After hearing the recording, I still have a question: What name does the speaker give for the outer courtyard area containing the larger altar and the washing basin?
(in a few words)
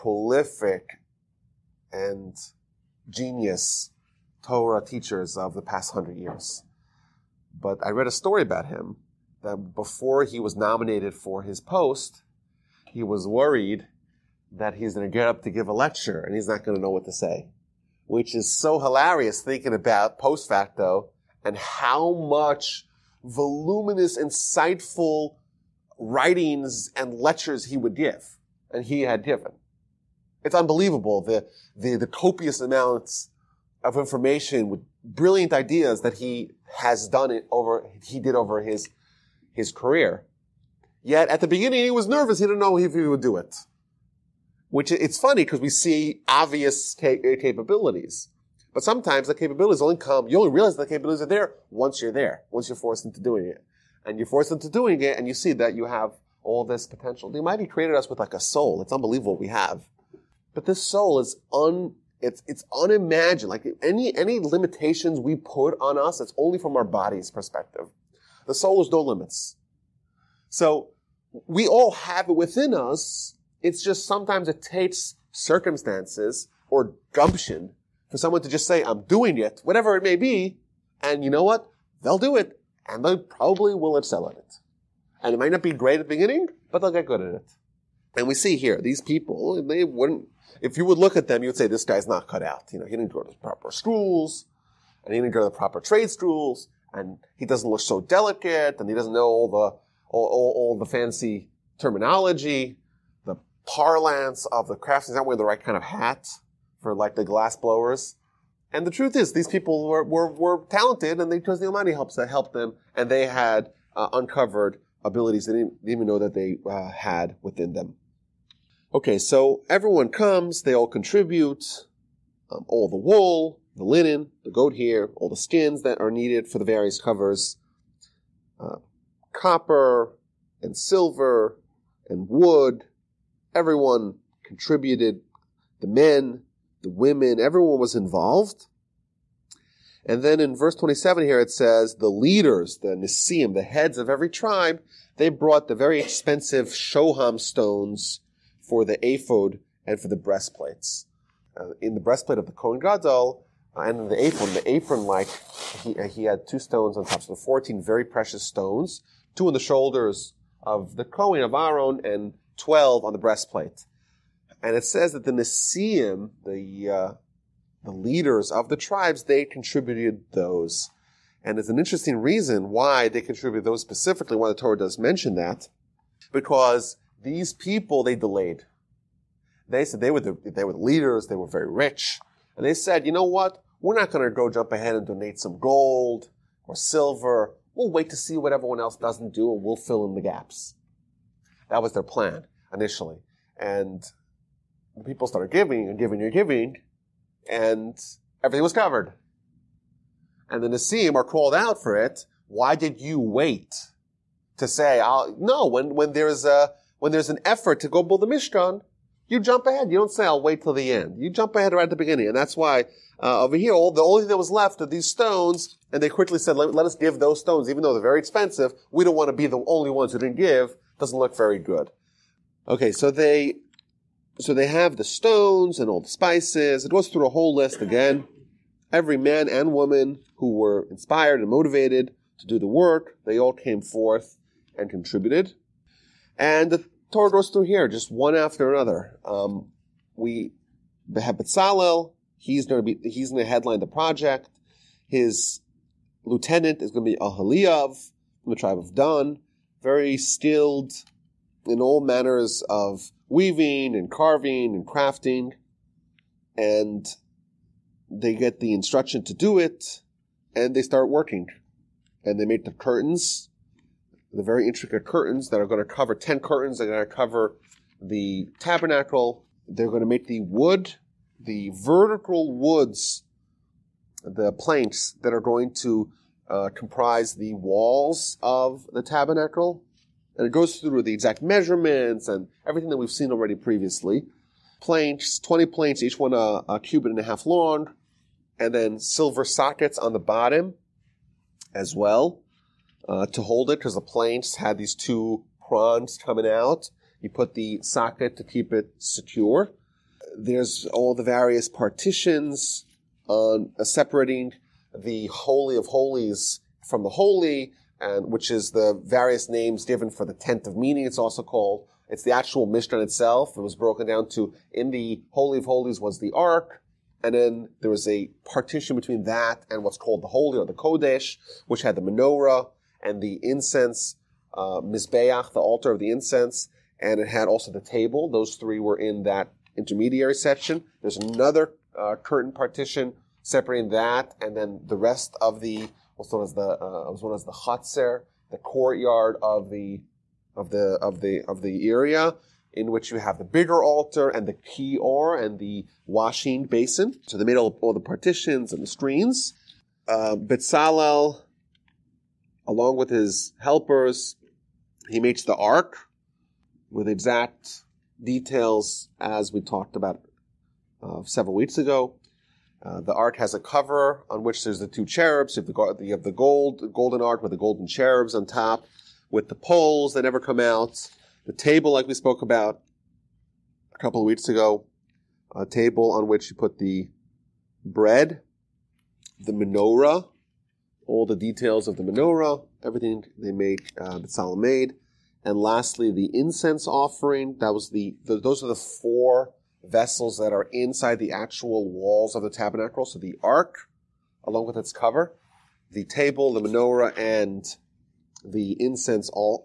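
Chatzer.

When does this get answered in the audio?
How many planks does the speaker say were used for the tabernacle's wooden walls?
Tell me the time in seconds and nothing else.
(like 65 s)
285 s.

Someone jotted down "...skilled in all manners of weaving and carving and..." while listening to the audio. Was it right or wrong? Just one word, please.
right.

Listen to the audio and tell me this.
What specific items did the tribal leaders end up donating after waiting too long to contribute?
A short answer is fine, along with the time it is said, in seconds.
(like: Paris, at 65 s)
Shoham stones, at 146 s.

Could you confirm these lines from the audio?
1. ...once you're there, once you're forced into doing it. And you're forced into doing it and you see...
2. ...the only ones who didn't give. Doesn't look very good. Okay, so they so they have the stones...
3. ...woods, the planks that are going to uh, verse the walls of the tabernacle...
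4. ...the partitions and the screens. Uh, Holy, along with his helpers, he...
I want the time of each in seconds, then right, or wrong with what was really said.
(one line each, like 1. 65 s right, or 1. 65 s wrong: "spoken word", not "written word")
1. 51 s right
2. 219 s right
3. 272 s wrong: "comprise", not "verse"
4. 347 s wrong: "Bezalel", not "Holy".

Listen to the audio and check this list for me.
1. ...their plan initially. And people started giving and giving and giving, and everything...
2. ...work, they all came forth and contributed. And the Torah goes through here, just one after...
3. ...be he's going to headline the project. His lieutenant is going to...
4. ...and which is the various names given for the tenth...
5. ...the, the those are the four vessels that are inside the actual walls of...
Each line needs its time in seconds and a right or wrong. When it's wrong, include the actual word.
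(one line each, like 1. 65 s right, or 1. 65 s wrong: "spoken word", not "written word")
1. 191 s right
2. 232 s right
3. 242 s right
4. 307 s right
5. 387 s right.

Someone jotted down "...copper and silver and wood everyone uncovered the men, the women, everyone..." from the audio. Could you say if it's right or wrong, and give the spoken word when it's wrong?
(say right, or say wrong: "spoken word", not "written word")
wrong: "contributed", not "uncovered".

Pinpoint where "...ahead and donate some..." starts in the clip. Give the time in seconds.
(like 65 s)
184 s.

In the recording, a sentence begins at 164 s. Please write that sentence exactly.
And it says that the Nesiim, the, uh, the leaders of the tribes, they contributed those.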